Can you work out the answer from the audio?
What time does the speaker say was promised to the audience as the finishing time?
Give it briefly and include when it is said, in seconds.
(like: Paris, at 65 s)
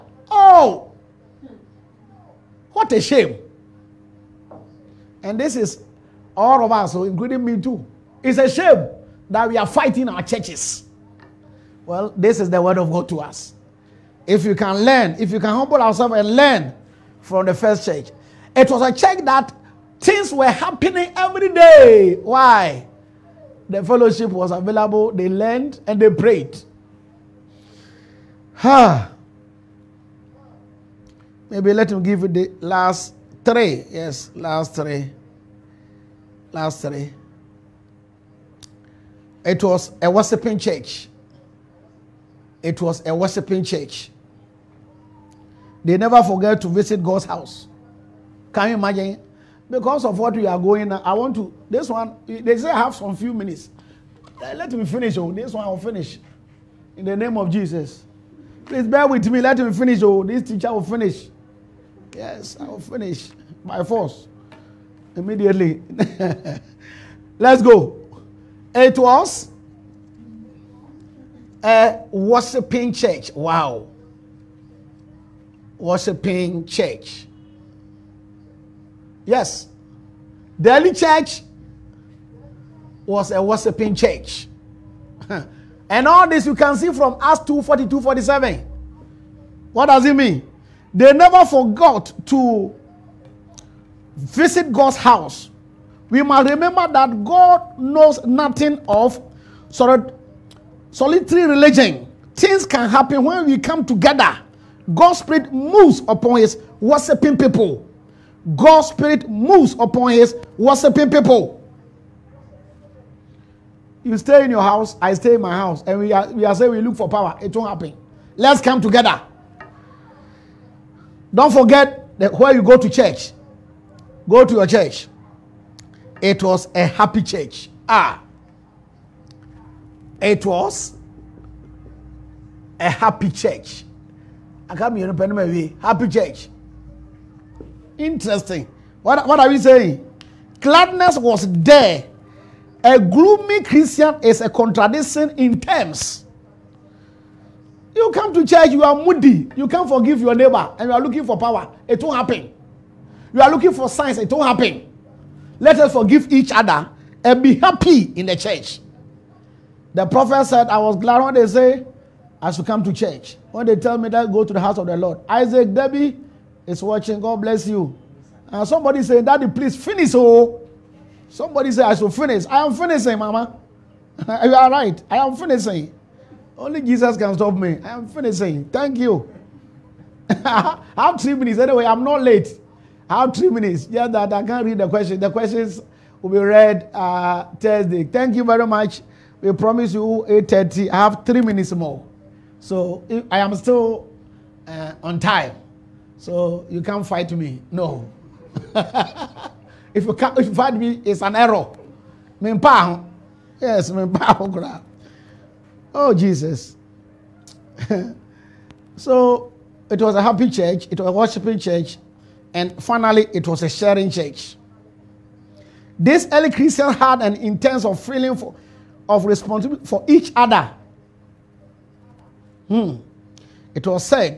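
8:30, at 190 s.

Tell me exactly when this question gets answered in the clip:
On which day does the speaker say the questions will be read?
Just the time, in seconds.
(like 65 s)
187 s.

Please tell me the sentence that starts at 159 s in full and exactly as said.
The prophet said, I was glad when they say, I should come to church.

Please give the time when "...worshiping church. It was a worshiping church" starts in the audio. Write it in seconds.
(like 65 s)
40 s.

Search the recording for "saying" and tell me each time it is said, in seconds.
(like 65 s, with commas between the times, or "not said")
116 s, 139 s, 169 s.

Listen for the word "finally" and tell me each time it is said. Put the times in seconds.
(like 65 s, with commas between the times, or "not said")
212 s.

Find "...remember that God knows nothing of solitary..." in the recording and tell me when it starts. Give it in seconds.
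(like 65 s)
96 s.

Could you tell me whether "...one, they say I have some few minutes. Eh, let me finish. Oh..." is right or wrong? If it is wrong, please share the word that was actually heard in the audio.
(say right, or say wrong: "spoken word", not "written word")
right.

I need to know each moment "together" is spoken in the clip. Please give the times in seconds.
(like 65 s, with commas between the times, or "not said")
103 s, 118 s.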